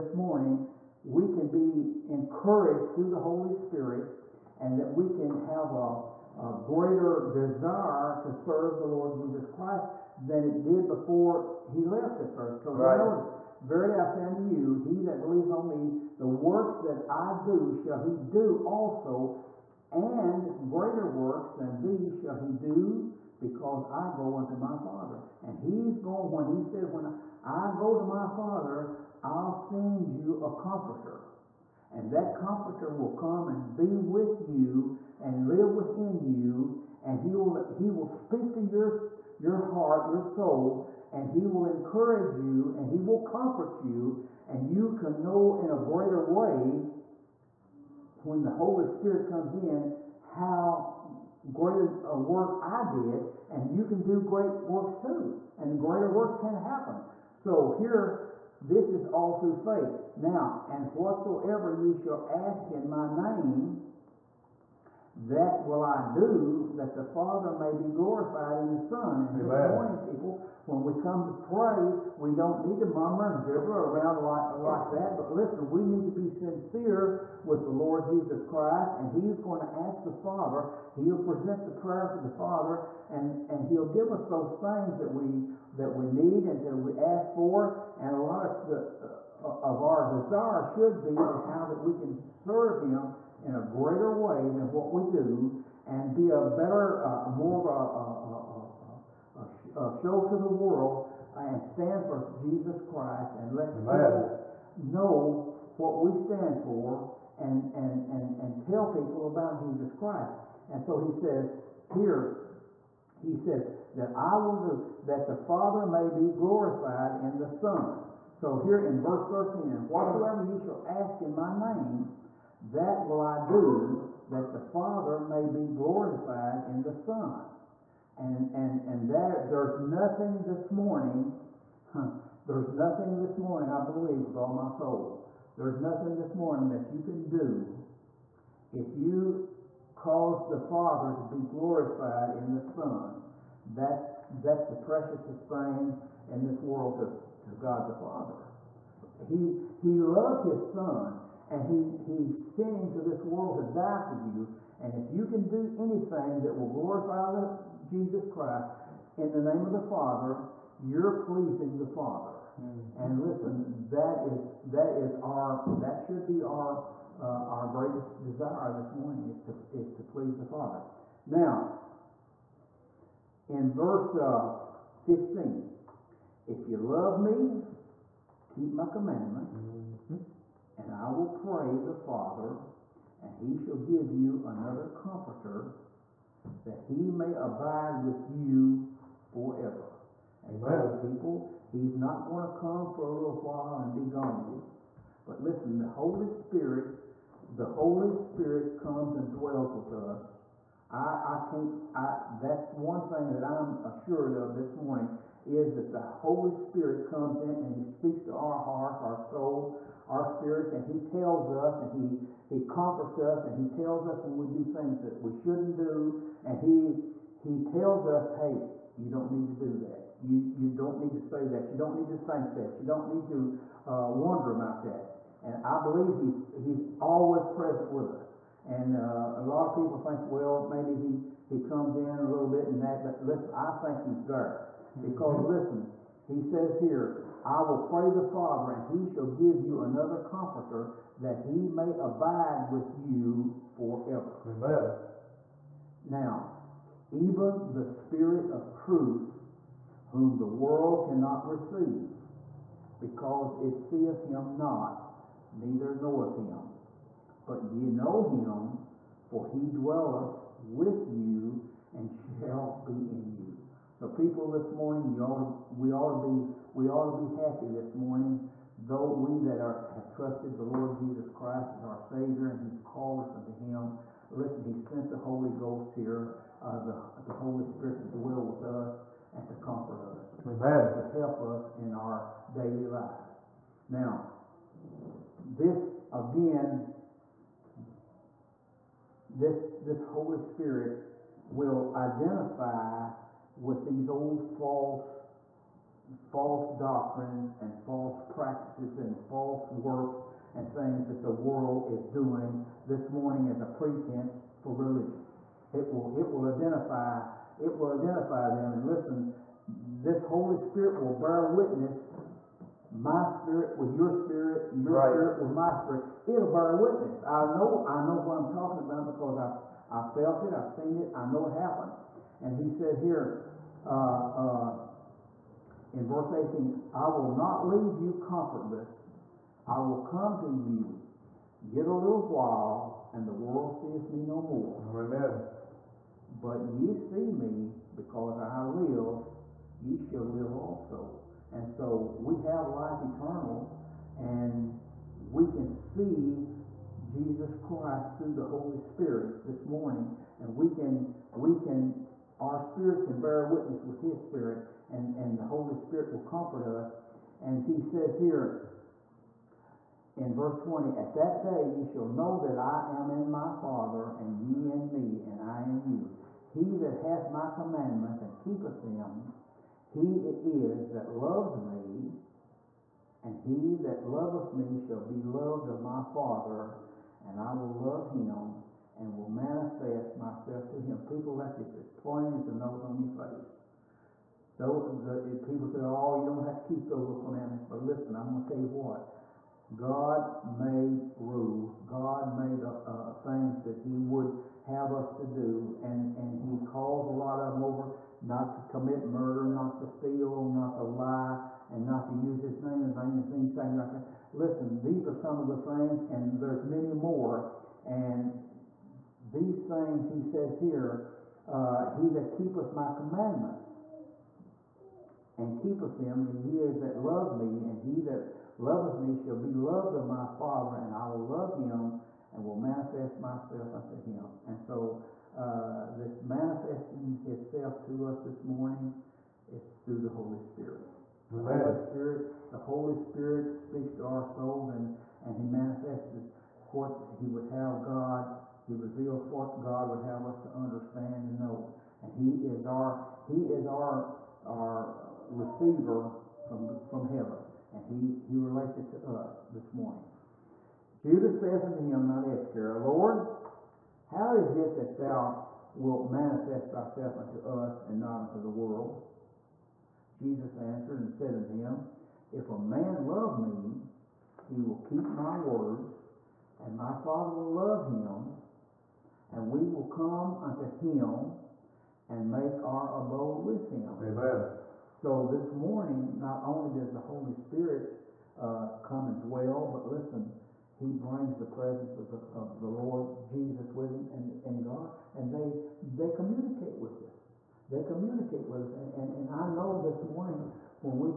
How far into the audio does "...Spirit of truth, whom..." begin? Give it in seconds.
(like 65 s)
247 s.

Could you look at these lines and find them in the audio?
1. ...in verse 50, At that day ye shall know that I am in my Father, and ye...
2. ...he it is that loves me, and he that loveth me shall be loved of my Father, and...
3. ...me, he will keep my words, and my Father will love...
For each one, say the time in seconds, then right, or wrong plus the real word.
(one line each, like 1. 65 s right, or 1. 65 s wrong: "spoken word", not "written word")
1. 360 s wrong: "20", not "50"
2. 369 s right
3. 463 s right.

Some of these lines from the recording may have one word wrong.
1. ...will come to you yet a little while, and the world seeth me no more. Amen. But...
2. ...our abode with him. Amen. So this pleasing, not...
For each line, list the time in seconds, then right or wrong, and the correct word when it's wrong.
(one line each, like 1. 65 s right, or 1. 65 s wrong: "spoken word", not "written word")
1. 329 s right
2. 472 s wrong: "morning", not "pleasing".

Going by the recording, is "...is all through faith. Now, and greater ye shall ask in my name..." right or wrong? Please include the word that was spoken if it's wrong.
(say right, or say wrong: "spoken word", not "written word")
wrong: "whatsoever", not "greater".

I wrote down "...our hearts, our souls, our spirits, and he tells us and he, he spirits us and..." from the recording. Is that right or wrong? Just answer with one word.
wrong.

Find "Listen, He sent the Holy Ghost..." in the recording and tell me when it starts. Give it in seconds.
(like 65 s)
274 s.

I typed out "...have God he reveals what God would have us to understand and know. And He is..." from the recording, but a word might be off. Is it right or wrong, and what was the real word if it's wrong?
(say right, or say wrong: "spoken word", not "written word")
right.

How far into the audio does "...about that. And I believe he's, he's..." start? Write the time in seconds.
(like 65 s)
224 s.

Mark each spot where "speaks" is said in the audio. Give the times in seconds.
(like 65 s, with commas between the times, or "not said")
38 s, 207 s, 433 s.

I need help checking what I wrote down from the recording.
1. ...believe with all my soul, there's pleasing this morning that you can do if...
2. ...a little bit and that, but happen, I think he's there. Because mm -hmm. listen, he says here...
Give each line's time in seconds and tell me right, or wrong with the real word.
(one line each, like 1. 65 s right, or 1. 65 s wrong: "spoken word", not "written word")
1. 133 s wrong: "nothing", not "pleasing"
2. 232 s wrong: "listen", not "happen".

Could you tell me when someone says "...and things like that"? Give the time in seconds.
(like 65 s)
403 s.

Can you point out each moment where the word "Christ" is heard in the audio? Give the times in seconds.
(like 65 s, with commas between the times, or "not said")
9 s, 78 s, 102 s, 109 s, 158 s, 271 s, 347 s.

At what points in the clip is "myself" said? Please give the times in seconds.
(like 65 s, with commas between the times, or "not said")
380 s, 423 s.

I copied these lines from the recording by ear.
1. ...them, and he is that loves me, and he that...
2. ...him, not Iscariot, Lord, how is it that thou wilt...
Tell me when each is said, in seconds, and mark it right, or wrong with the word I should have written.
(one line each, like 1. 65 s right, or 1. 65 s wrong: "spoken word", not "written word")
1. 415 s right
2. 451 s right.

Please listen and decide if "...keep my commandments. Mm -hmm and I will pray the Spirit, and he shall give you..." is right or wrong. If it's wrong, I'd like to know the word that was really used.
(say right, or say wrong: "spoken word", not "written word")
wrong: "Father", not "Spirit".